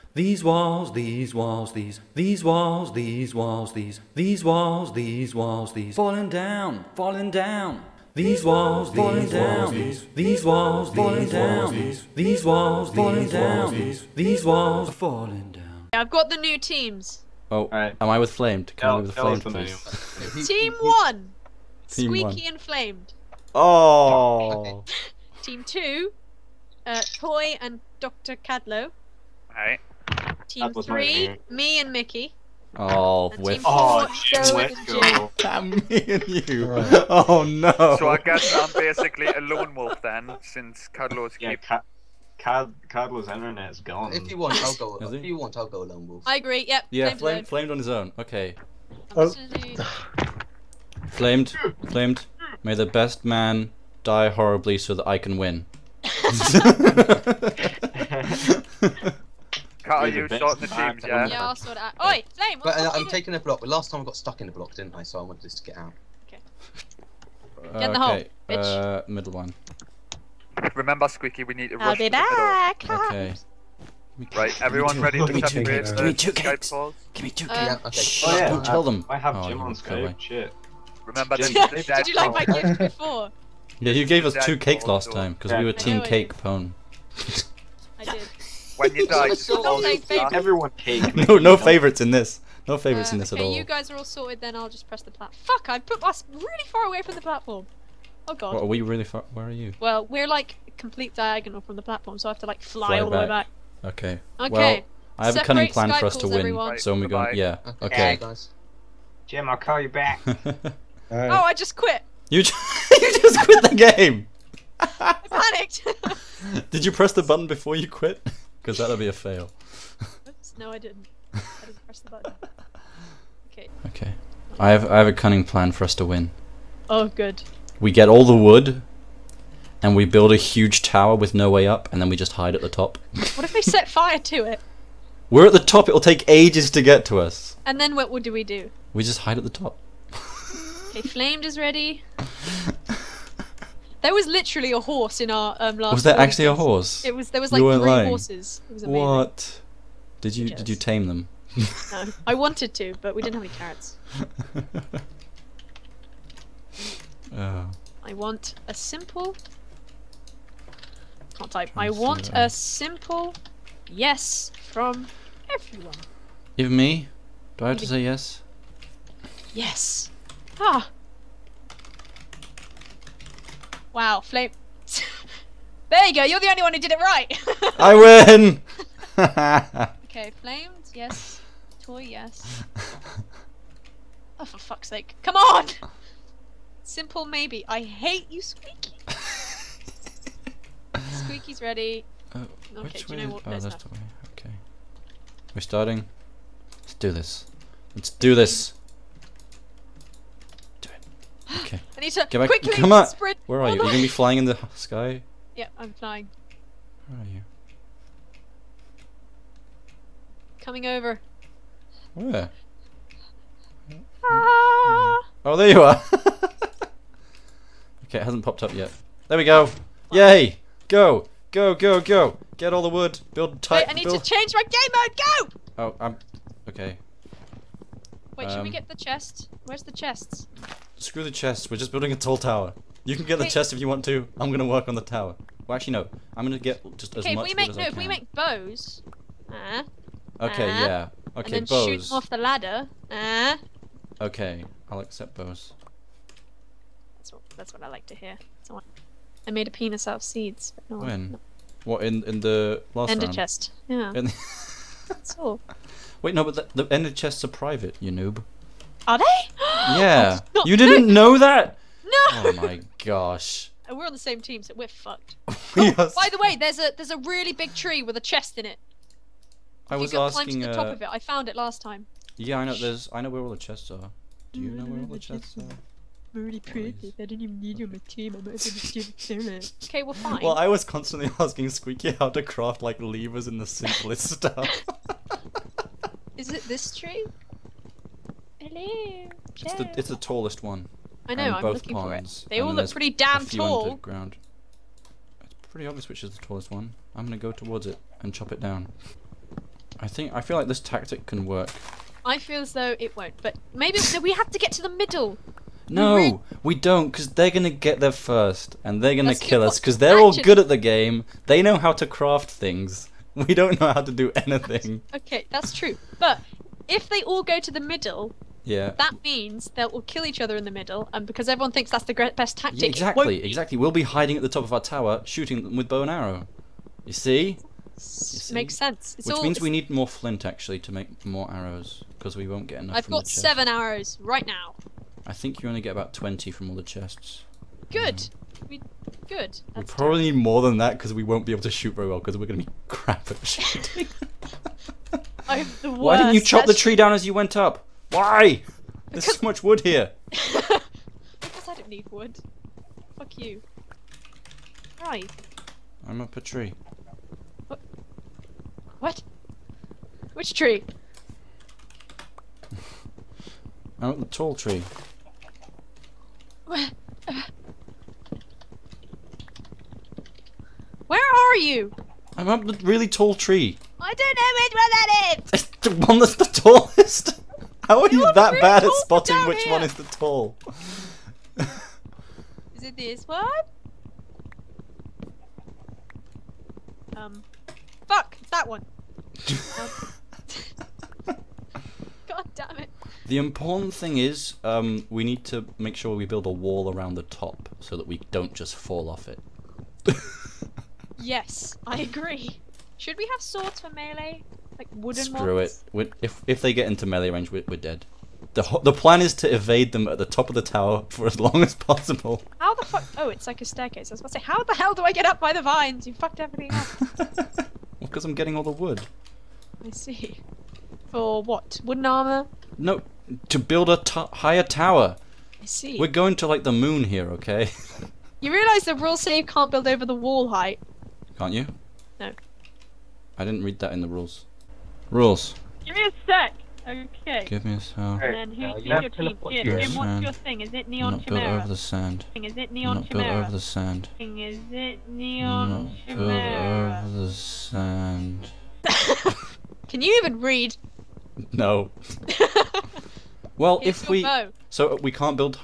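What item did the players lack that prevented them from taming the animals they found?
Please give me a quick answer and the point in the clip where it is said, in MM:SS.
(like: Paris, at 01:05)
Carrots, at 02:33.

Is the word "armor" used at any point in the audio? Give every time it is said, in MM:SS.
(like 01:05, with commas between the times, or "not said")
07:02.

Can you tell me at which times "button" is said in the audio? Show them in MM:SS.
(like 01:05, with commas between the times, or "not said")
01:57, 02:02.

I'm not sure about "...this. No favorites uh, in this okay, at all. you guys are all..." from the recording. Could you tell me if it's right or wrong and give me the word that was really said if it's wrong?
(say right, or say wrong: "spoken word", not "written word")
right.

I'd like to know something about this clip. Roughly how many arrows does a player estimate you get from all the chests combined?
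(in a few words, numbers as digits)
About 20.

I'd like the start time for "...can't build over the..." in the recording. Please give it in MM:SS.
07:09.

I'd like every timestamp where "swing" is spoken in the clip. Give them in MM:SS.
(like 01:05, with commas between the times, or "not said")
not said.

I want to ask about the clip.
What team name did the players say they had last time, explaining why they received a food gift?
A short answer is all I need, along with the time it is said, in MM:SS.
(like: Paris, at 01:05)
Team Cake Pone, at 01:25.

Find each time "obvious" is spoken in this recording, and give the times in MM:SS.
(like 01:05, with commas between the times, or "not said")
04:55.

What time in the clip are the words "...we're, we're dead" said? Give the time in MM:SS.
06:47.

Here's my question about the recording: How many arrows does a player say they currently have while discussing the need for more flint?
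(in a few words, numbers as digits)
7.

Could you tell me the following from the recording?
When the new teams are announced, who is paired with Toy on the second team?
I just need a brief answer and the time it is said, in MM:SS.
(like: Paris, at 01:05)
Doctor Cadlo, at 00:27.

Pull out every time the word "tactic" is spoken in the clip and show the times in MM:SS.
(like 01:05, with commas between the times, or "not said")
05:00, 05:22.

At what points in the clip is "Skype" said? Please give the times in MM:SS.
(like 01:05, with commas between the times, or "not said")
01:19, 01:45.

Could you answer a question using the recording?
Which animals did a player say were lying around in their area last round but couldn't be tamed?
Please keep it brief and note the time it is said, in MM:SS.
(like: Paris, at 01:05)
Horses, at 02:28.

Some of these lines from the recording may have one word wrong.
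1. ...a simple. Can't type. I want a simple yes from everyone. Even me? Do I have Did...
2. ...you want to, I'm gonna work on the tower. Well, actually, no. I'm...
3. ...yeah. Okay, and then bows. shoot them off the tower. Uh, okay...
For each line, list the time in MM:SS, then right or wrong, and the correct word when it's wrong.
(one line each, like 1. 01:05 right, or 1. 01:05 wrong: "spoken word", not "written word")
1. 02:38 wrong: "Even", not "Did"
2. 03:53 right
3. 04:00 wrong: "ladder", not "tower".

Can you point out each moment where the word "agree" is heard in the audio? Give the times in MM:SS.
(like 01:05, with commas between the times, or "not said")
00:46, 06:42.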